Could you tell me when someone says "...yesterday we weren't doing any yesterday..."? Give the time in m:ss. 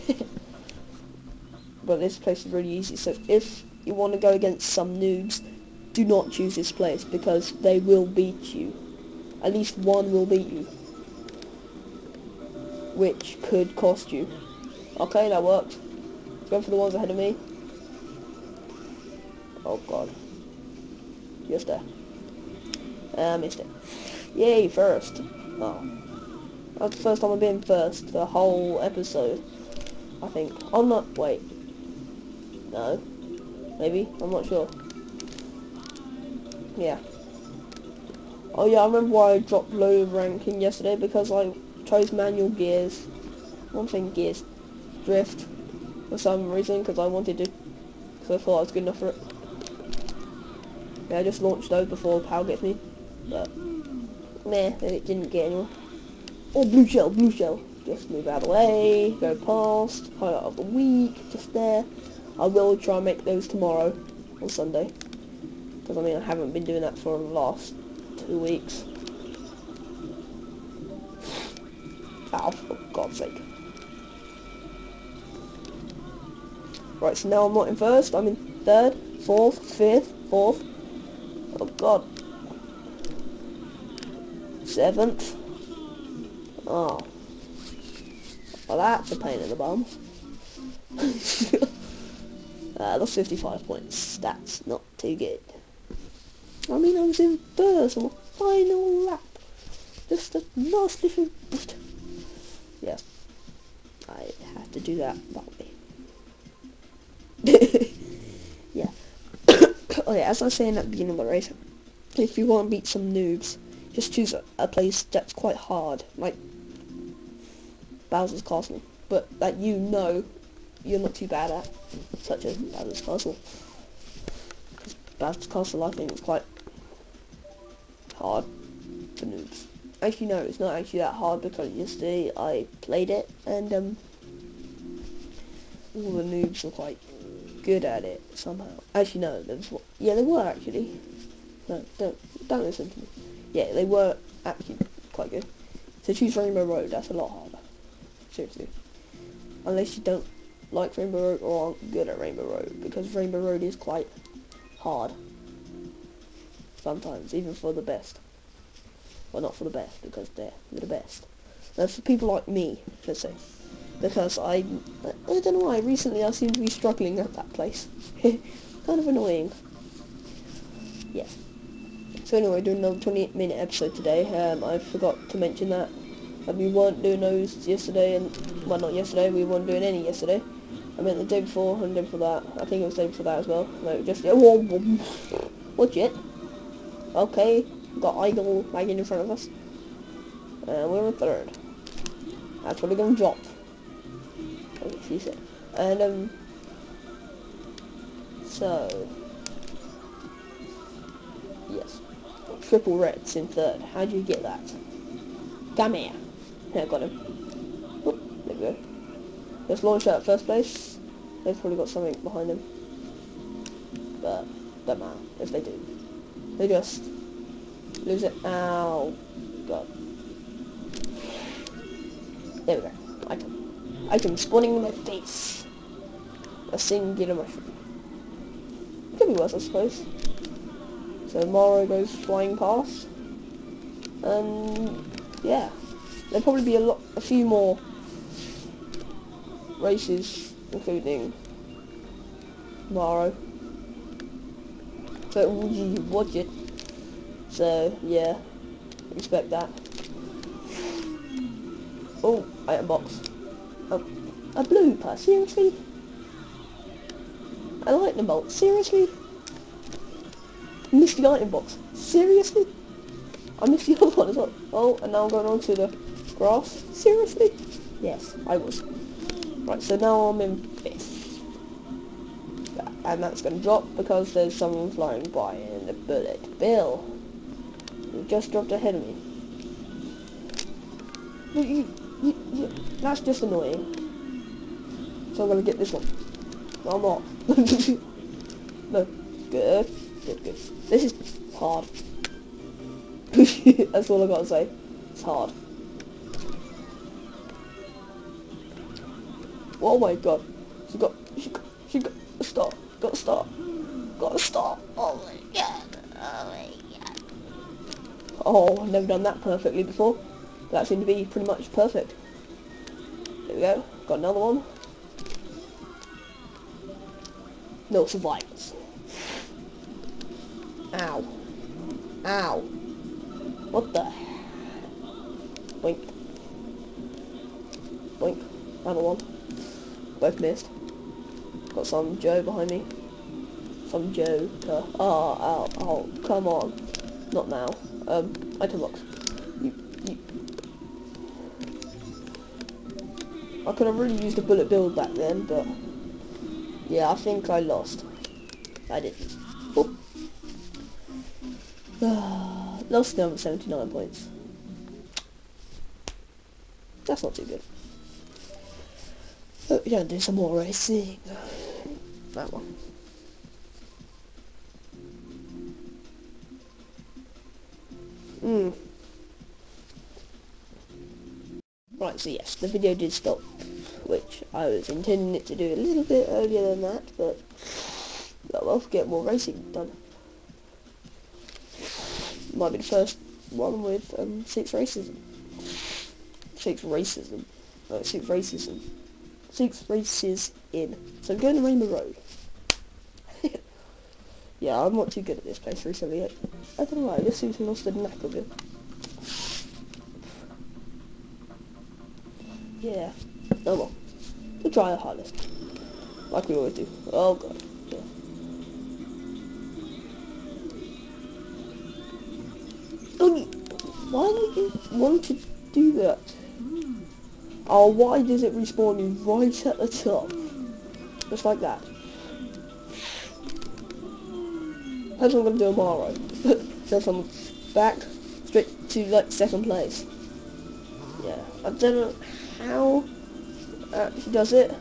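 2:58.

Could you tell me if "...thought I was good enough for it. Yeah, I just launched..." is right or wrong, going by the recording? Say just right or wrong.
right.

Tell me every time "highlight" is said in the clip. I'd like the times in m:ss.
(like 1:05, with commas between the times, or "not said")
1:00.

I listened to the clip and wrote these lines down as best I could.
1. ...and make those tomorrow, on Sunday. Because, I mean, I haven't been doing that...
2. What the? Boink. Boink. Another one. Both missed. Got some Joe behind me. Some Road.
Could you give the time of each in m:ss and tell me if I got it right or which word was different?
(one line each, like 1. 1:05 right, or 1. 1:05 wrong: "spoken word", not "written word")
1. 1:02 right
2. 5:23 wrong: "Joe", not "Road".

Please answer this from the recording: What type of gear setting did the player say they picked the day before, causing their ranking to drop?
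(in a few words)
manual gears.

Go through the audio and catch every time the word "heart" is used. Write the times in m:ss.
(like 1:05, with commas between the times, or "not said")
not said.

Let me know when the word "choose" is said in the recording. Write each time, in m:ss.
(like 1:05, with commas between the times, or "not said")
0:06, 1:54, 2:26.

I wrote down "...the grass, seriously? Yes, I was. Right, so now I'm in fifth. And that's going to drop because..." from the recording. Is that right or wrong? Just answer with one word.
right.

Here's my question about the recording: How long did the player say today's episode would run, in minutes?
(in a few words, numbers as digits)
28.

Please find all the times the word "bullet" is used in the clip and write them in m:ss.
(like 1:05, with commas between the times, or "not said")
4:35, 5:44.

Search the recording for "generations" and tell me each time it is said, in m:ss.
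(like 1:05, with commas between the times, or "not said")
not said.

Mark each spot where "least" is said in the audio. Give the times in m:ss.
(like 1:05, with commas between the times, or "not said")
0:09.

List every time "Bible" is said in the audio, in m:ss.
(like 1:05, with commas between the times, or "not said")
not said.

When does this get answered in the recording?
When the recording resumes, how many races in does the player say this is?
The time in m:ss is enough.
6:29.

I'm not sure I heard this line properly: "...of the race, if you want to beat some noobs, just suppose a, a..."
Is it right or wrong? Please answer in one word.
wrong.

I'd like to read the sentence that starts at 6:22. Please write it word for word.
Might be the first one with um, six racism.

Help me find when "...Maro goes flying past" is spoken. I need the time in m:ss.
3:51.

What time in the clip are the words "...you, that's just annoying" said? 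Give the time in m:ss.
4:42.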